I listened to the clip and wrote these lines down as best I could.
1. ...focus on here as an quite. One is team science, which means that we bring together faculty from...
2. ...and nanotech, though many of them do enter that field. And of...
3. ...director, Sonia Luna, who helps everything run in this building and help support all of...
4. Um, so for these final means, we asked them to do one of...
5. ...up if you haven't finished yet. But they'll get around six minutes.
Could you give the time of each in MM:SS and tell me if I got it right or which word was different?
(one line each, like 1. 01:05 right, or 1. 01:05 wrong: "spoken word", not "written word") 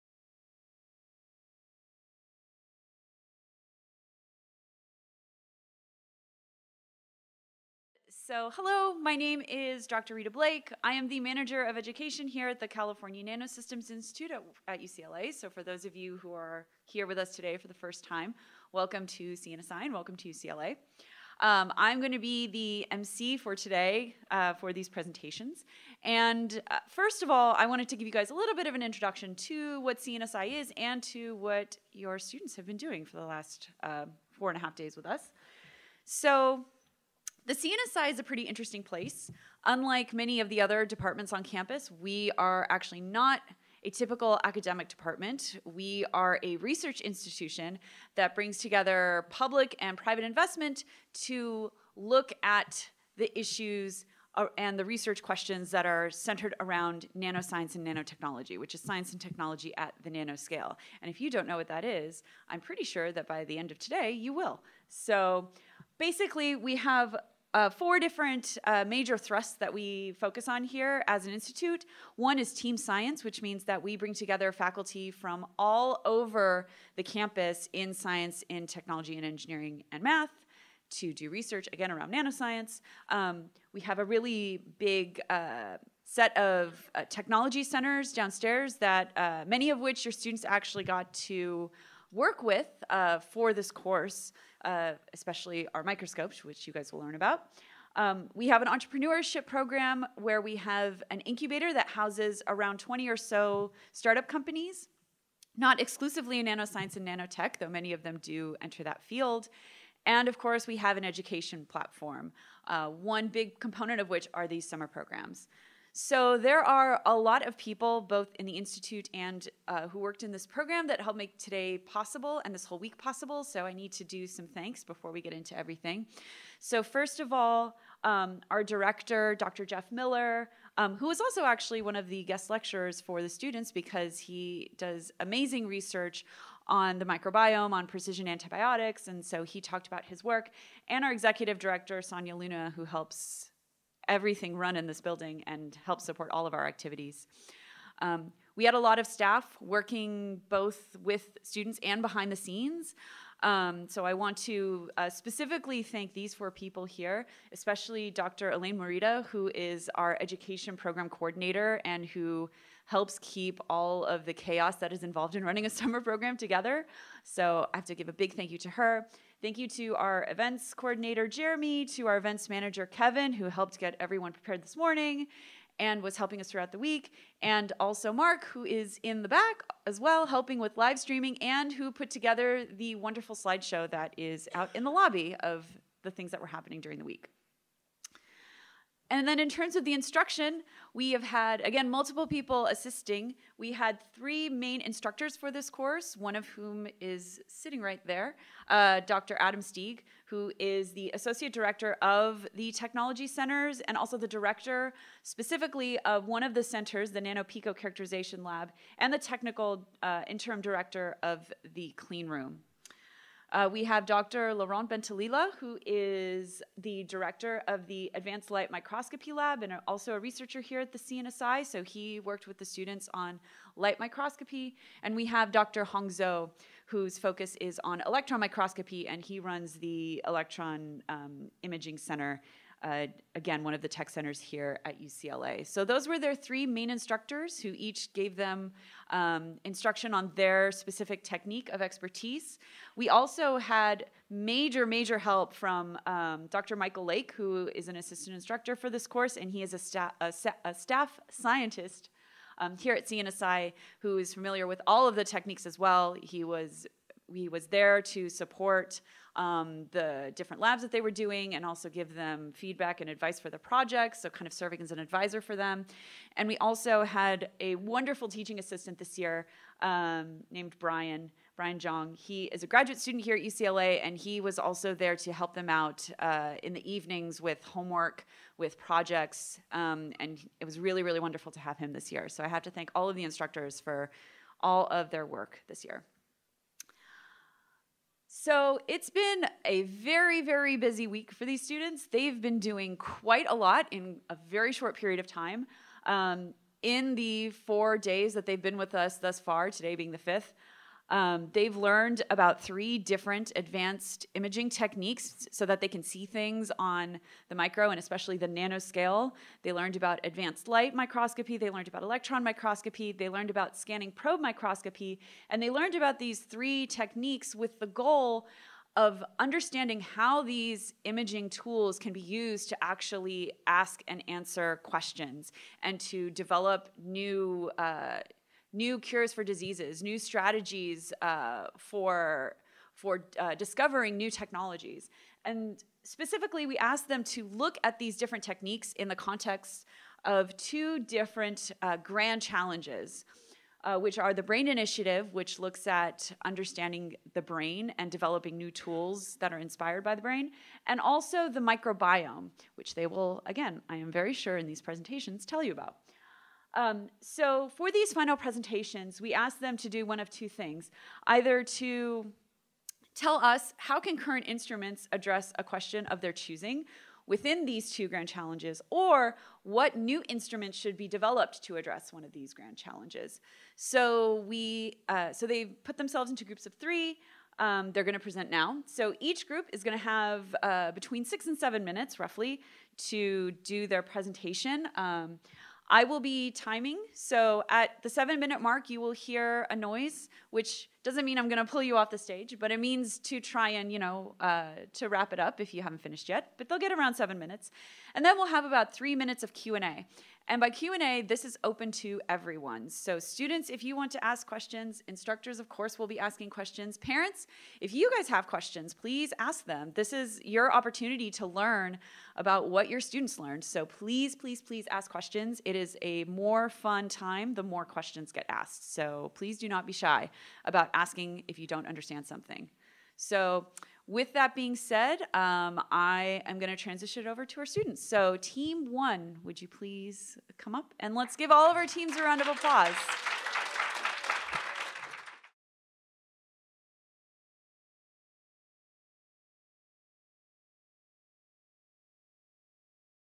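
1. 01:10 wrong: "institute", not "quite"
2. 01:46 right
3. 02:21 right
4. 05:56 wrong: "presentations", not "means"
5. 06:35 wrong: "seven", not "six".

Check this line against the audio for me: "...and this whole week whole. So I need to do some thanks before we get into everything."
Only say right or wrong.
wrong.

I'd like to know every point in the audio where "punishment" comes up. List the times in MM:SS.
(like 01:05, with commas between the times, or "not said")
not said.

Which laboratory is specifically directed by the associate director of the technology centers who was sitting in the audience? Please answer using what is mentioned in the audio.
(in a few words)
NanoPico Characterization Lab.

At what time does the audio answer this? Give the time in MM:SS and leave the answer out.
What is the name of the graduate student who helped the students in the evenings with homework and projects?
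04:31.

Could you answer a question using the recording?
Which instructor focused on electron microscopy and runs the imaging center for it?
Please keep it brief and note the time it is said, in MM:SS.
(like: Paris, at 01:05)
Dr. Hong Zhou, at 03:45.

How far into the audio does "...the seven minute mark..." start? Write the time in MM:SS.
06:28.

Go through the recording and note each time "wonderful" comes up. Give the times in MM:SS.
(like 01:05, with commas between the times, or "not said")
03:02, 04:27, 04:41.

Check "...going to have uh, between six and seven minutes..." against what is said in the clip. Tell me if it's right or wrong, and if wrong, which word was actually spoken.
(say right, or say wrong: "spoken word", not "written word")
right.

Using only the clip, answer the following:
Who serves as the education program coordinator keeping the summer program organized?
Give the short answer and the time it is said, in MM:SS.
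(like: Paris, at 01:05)
Dr. Elaine Morita, at 02:38.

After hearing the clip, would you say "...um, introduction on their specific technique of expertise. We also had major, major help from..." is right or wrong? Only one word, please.
wrong.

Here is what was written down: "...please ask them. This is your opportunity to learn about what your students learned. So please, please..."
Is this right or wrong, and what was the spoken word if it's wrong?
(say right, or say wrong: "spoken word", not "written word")
right.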